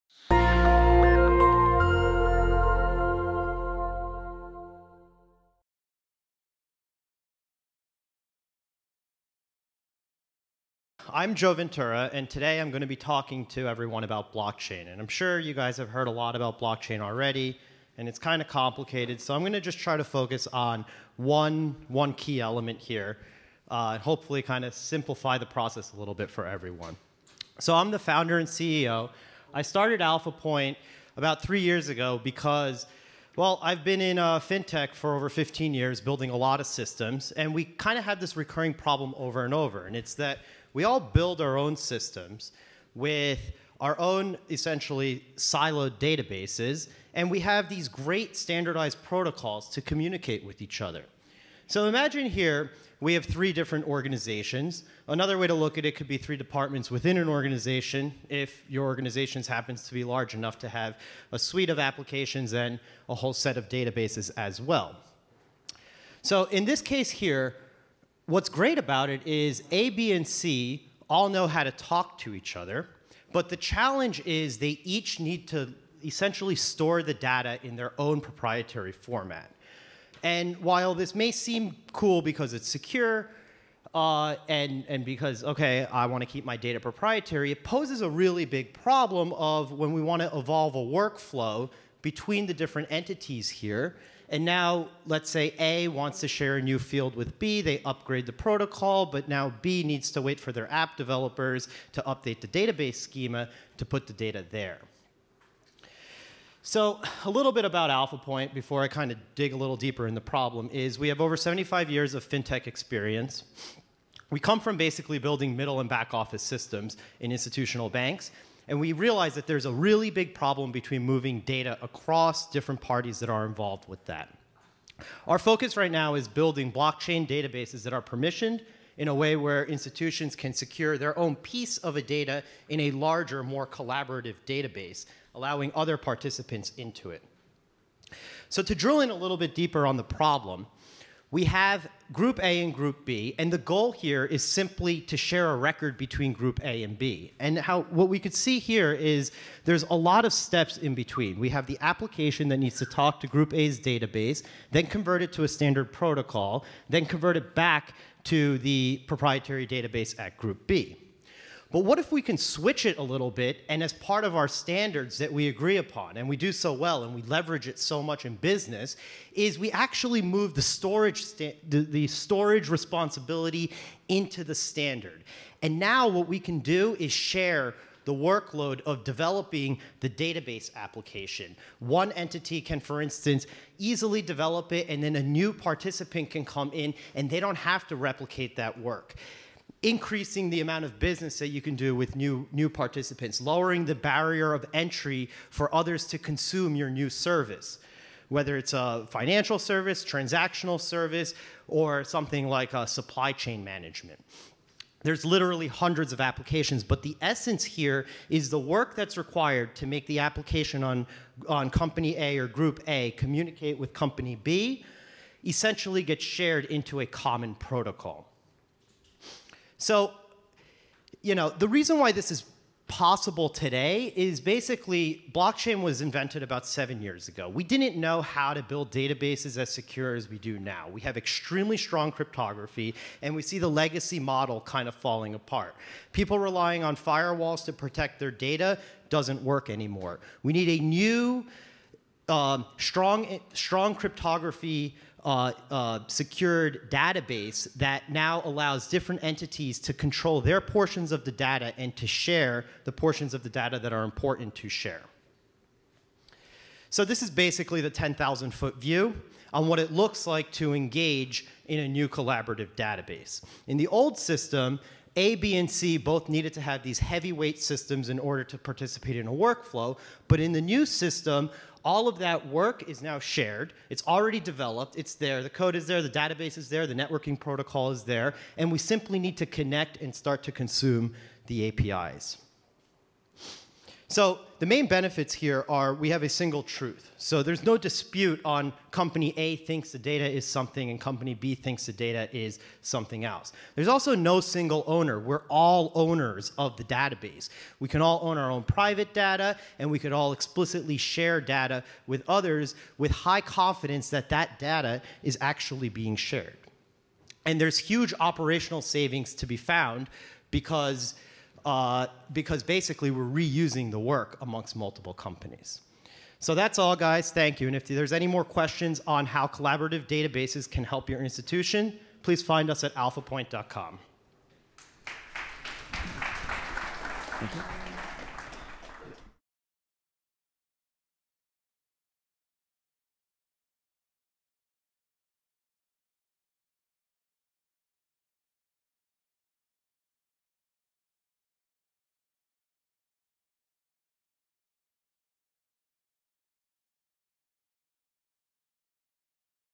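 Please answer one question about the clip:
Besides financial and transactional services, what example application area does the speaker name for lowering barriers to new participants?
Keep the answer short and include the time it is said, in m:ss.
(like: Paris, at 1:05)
supply chain management, at 3:22.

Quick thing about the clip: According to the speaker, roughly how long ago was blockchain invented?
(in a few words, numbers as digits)
about 7 years ago.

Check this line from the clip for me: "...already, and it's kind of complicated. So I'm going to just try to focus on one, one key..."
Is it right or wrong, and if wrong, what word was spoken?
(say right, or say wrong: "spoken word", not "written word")
right.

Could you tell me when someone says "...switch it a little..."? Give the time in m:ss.
2:42.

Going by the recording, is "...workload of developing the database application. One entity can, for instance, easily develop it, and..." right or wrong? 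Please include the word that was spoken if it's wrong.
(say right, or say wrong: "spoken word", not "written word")
right.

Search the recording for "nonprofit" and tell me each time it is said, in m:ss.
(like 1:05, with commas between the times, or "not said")
not said.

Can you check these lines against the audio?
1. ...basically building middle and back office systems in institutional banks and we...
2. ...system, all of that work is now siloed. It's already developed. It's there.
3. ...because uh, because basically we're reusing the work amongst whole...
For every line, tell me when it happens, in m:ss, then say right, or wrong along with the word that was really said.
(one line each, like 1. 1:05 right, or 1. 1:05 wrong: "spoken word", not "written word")
1. 1:54 right
2. 4:30 wrong: "shared", not "siloed"
3. 5:10 wrong: "multiple", not "whole".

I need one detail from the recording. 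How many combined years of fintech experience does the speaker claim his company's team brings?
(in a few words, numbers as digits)
over 75 years.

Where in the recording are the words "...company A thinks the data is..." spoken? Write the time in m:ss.
4:48.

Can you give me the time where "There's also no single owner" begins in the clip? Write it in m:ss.
4:53.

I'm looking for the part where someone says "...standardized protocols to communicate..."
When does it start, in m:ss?
0:48.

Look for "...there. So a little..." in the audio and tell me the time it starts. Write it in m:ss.
1:44.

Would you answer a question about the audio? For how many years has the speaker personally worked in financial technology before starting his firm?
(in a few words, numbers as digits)
over 15 years.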